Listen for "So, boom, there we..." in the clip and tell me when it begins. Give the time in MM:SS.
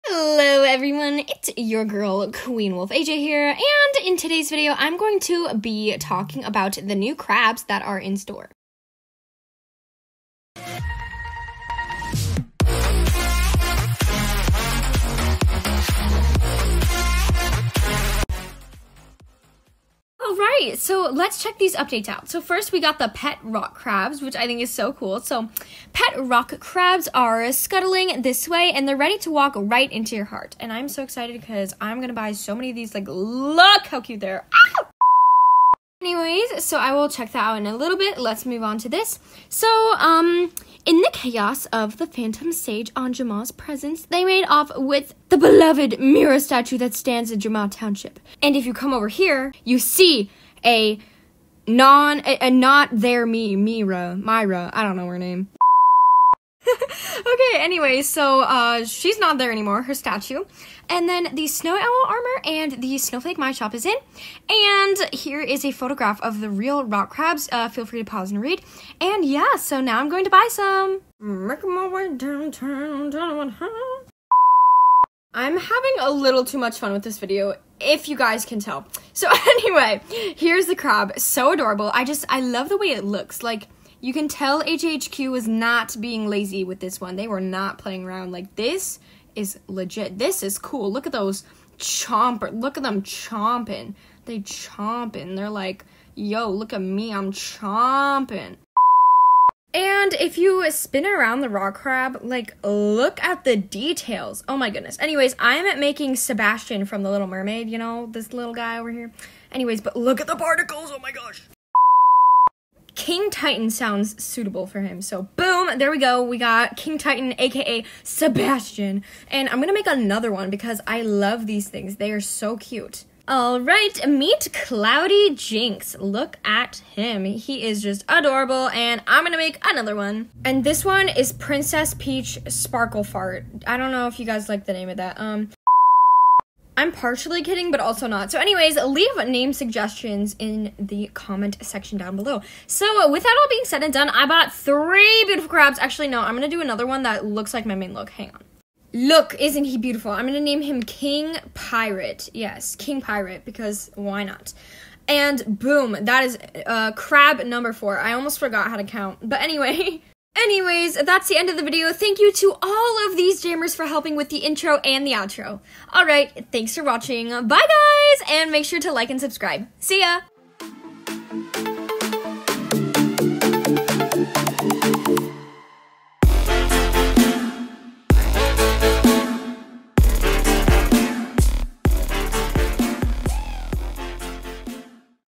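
01:55.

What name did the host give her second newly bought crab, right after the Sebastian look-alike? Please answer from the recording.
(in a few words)
Cloudy Jinx.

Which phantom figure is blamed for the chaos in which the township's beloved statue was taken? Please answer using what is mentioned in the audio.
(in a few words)
Anjuma.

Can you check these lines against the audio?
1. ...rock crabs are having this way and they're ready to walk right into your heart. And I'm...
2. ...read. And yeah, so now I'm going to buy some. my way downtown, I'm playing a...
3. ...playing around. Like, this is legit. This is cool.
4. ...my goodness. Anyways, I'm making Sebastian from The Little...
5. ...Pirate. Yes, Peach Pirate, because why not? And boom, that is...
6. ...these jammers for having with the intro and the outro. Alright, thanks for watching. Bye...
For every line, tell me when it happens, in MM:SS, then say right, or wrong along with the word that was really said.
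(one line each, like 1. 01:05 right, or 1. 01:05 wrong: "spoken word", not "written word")
1. 00:26 wrong: "scuttling", not "having"
2. 01:08 wrong: "having", not "playing"
3. 01:27 right
4. 01:44 right
5. 02:31 wrong: "King", not "Peach"
6. 02:43 wrong: "helping", not "having".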